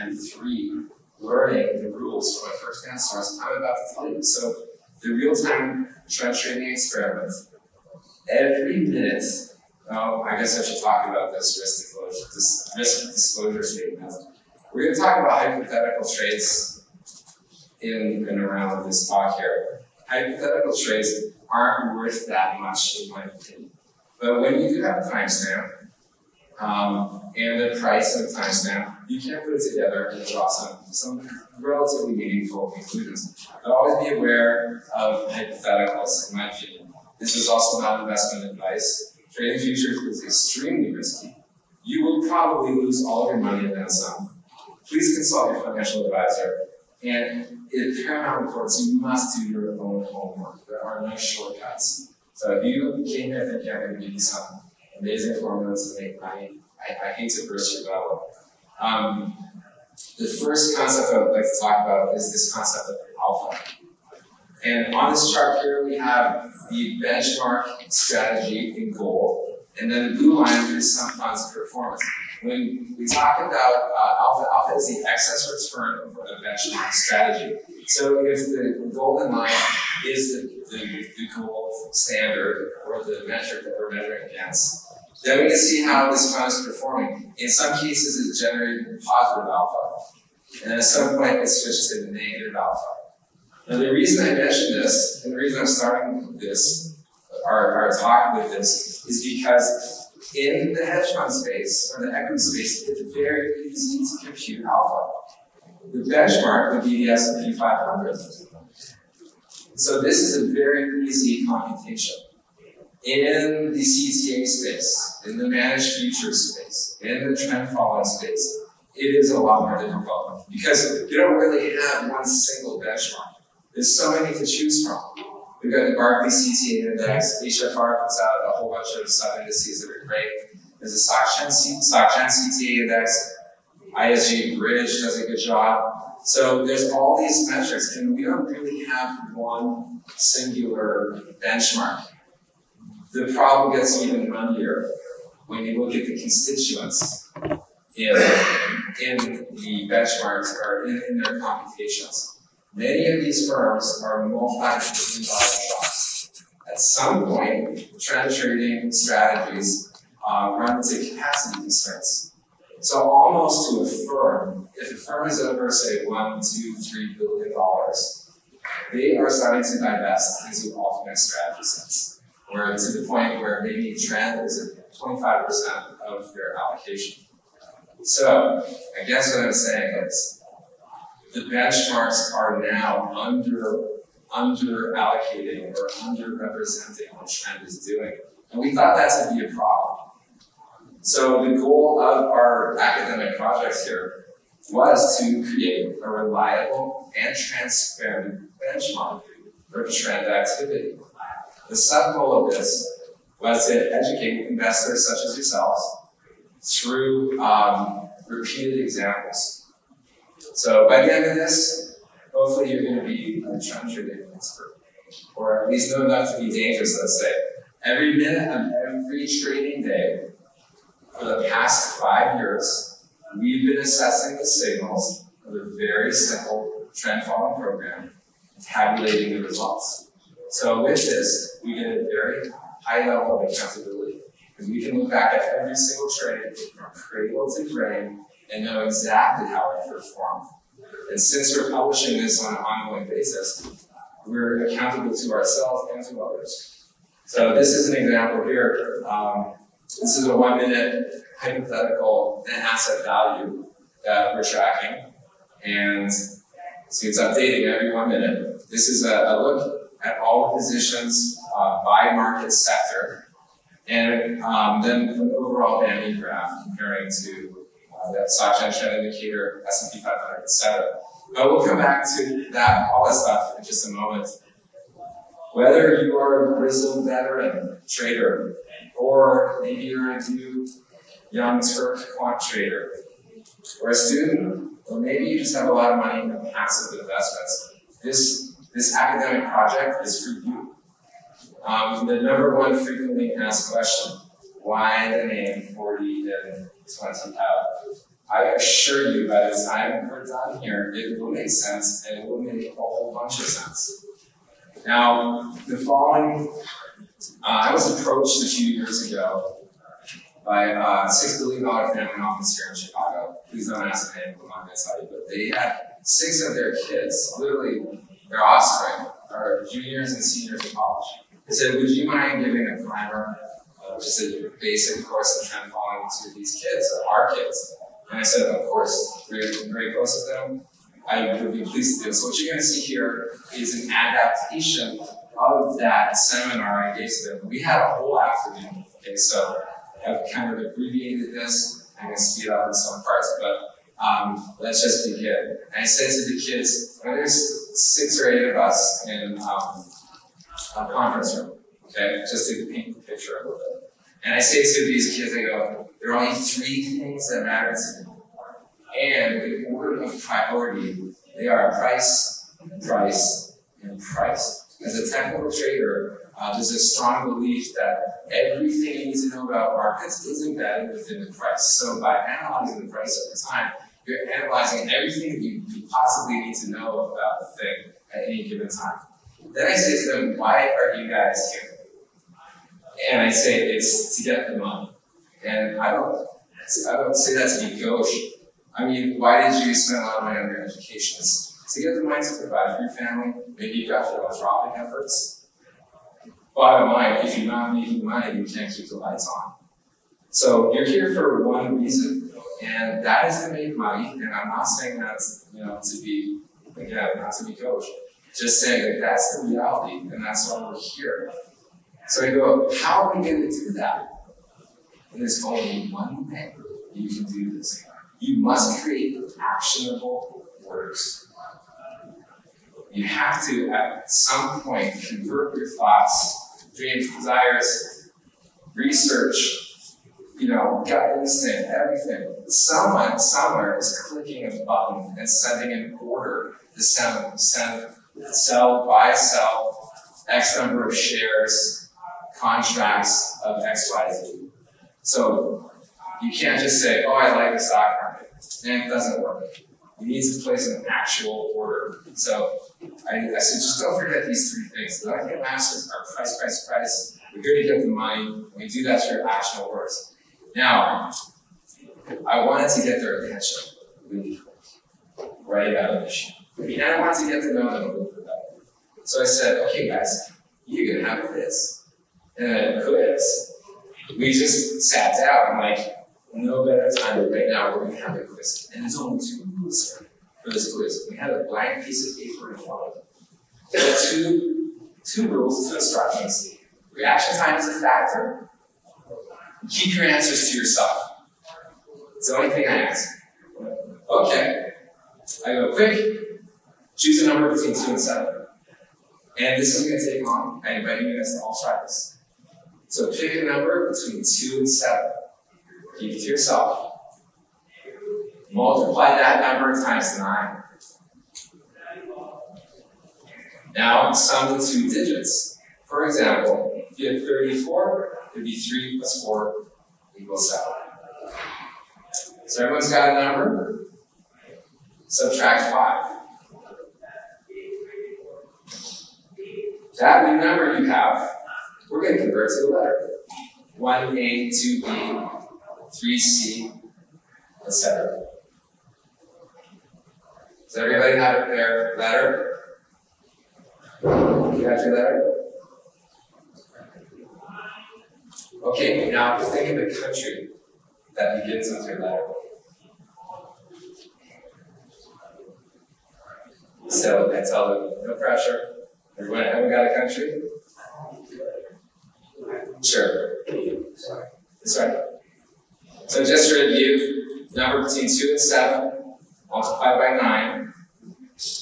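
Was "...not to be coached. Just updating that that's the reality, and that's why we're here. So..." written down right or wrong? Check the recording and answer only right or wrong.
wrong.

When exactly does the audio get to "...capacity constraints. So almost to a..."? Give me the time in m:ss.
2:41.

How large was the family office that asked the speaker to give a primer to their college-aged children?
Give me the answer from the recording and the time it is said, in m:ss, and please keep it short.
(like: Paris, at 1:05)
$6 billion, at 5:11.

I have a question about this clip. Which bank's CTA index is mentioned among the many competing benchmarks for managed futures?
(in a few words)
SocGen.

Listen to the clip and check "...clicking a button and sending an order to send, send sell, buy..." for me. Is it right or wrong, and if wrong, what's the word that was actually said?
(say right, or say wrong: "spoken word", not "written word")
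right.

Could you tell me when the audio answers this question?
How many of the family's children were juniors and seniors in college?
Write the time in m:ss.
5:16.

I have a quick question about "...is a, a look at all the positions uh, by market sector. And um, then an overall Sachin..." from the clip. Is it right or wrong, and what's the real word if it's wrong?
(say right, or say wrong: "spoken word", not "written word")
wrong: "Bambi", not "Sachin".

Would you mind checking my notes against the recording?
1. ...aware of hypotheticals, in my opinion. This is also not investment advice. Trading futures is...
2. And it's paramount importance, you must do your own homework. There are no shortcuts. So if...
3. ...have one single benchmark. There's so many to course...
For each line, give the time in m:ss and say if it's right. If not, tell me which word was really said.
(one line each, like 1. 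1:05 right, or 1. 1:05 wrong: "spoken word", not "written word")
1. 0:34 right
2. 0:47 right
3. 2:01 wrong: "choose", not "course".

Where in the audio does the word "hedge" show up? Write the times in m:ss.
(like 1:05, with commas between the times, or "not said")
1:40.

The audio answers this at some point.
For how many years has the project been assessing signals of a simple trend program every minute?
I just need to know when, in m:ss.
3:42.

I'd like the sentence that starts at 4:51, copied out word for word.
Um, the number one frequently asked question, why the name 40 and this one somehow.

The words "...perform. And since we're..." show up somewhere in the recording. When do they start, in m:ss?
3:59.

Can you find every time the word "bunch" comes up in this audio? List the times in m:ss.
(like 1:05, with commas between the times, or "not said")
2:08, 5:03.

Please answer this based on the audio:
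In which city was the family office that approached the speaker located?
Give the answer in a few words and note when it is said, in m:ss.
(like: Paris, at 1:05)
Chicago, at 5:12.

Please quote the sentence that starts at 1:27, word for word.
In some cases, it's generating positive alpha, and at some point, it switches to negative alpha.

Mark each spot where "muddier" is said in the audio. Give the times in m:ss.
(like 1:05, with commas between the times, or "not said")
2:24.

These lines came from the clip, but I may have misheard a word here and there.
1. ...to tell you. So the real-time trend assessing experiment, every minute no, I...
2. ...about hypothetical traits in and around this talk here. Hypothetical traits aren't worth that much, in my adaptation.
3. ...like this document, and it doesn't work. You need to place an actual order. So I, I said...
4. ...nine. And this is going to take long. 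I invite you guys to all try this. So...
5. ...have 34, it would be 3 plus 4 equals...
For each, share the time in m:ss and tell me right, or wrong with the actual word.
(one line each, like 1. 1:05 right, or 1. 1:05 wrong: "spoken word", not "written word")
1. 0:03 wrong: "trading", not "assessing"
2. 0:15 wrong: "opinion", not "adaptation"
3. 7:27 right
4. 8:18 wrong: "seven", not "nine"
5. 8:37 right.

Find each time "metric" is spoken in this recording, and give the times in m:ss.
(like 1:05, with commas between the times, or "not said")
1:23, 2:17.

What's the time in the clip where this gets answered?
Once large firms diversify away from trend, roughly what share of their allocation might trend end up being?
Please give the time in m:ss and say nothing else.
2:54.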